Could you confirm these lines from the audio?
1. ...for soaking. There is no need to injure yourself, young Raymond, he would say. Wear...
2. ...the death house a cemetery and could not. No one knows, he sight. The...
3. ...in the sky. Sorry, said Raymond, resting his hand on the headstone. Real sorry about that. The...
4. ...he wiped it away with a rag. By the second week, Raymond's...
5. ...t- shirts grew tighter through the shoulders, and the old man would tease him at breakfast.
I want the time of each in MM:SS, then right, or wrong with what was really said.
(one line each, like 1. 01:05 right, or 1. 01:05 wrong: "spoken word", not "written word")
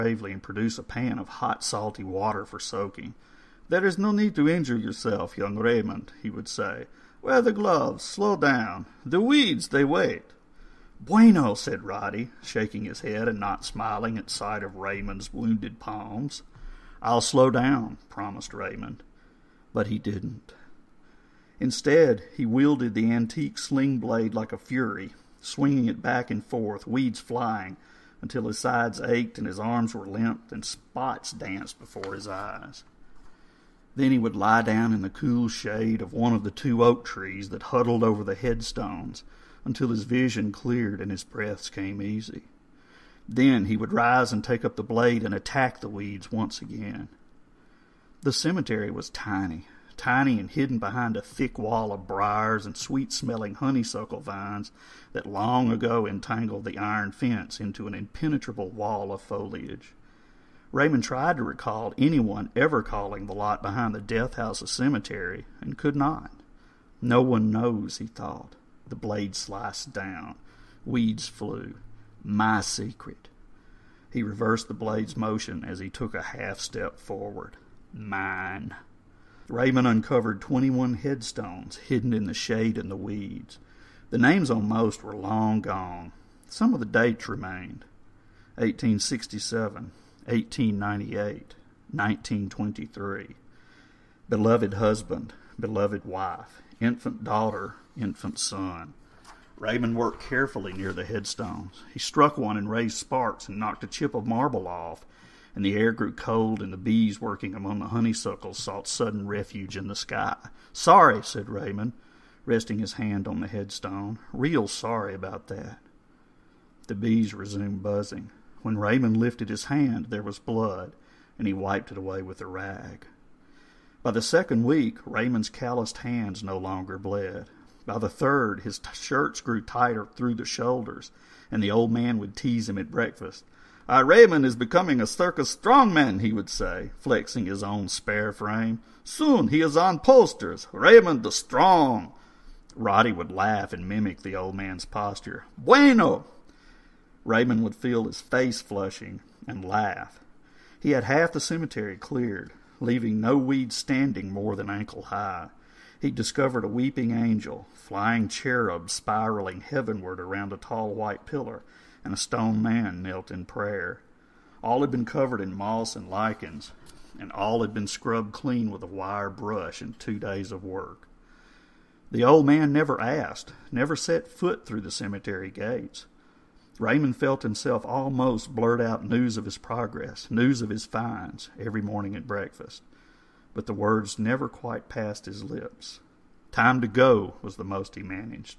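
1. 00:02 right
2. 01:03 wrong: "thought", not "sight"
3. 01:49 right
4. 02:01 right
5. 02:08 right.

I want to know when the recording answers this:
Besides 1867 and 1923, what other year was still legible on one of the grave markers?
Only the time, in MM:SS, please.
01:30.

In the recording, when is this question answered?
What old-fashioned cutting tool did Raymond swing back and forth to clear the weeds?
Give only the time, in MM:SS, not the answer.
00:23.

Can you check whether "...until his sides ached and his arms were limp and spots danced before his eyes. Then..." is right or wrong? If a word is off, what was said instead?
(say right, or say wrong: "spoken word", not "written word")
right.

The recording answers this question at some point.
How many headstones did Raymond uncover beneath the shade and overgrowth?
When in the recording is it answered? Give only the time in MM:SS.
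01:20.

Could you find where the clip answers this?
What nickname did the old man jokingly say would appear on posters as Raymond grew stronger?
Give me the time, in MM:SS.
02:20.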